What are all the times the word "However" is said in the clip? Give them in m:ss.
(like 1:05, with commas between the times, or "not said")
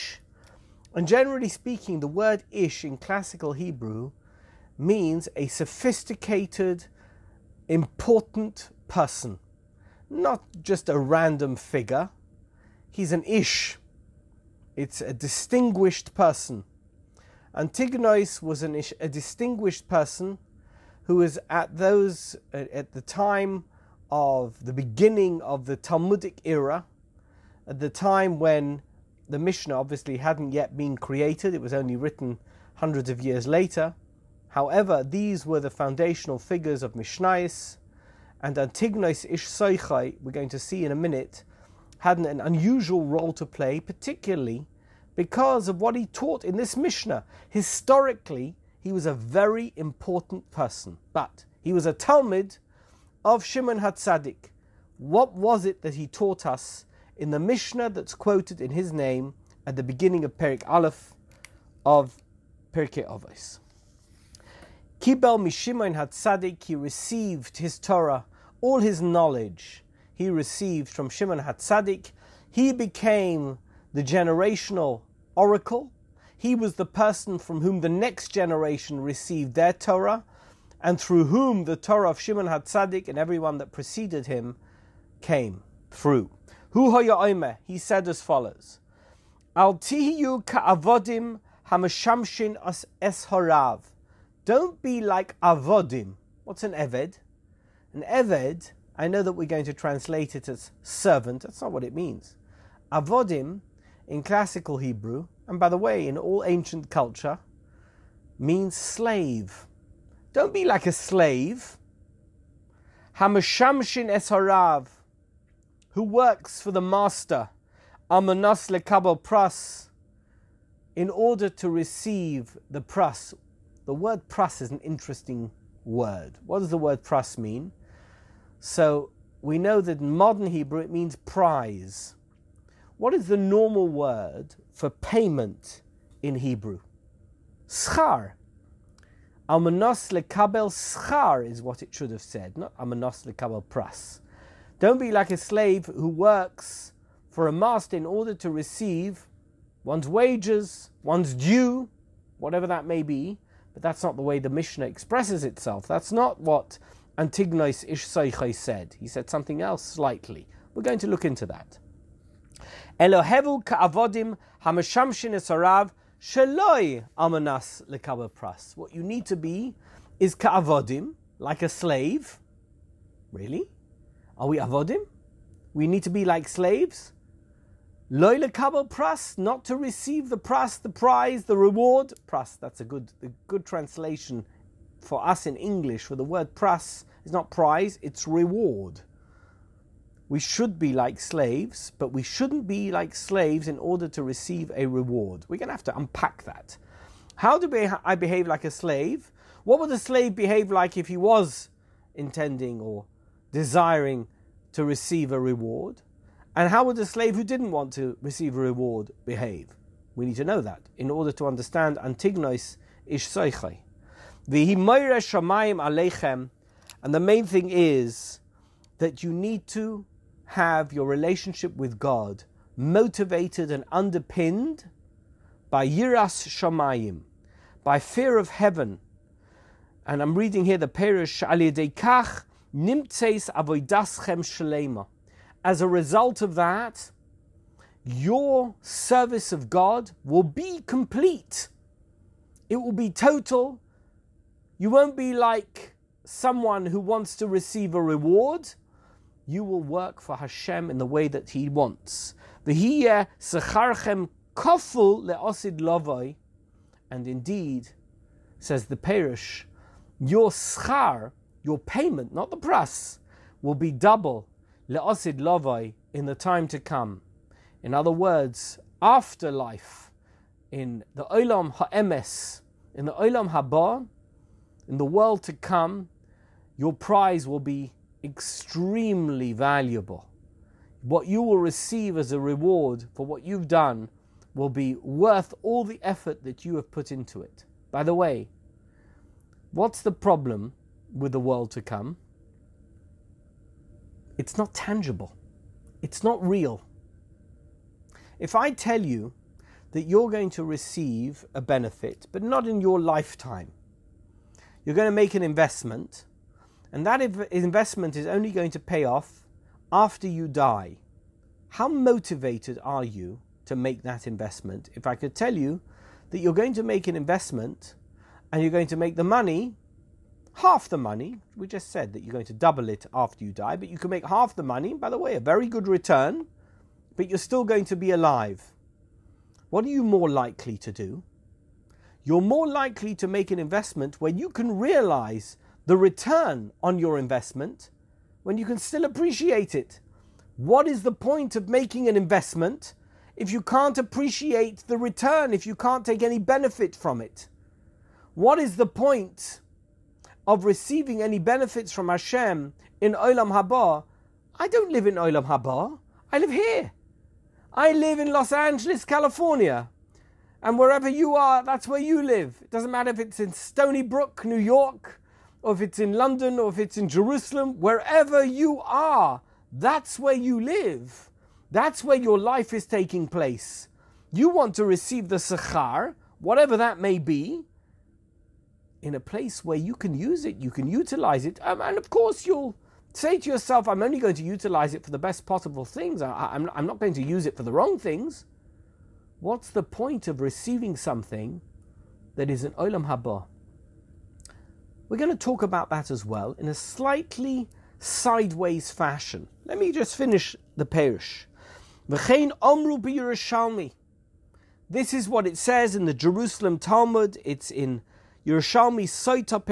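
0:34.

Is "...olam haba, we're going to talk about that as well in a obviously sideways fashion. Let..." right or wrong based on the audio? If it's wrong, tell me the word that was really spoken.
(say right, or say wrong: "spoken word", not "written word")
wrong: "slightly", not "obviously".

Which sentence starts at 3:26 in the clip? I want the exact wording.
And how would a slave who didn't want to receive a reward behave?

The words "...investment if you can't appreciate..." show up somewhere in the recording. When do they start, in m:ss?
5:42.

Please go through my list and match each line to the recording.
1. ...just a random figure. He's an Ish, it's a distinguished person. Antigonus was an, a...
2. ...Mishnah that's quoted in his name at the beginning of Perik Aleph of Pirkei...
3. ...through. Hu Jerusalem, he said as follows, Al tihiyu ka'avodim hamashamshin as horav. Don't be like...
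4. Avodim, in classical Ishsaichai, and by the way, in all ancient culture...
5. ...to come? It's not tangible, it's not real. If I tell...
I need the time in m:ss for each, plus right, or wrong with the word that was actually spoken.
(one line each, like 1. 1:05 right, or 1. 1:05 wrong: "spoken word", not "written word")
1. 0:10 right
2. 0:57 right
3. 1:25 wrong: "Omer", not "Jerusalem"
4. 1:42 wrong: "Hebrew", not "Ishsaichai"
5. 4:51 right.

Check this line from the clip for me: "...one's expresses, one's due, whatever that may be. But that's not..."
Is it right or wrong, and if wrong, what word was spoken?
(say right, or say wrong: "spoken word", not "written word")
wrong: "wages", not "expresses".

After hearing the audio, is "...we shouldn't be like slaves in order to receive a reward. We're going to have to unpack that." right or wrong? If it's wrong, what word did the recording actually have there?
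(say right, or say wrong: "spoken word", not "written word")
right.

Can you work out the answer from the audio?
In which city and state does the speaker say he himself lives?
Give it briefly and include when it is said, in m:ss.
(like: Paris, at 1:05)
Los Angeles, California, at 5:58.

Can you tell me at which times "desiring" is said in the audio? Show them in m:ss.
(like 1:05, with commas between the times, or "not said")
3:23.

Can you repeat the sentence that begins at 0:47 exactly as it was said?
Historically, he was a very important person, but he was a Talmid of Shimon HaTzadik.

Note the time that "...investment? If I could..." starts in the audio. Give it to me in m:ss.
5:14.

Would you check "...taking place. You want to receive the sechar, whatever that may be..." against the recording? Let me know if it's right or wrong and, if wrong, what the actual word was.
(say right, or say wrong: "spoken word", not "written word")
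right.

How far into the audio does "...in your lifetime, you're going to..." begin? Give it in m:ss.
5:02.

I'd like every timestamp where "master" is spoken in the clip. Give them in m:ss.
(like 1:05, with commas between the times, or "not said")
1:56, 2:27.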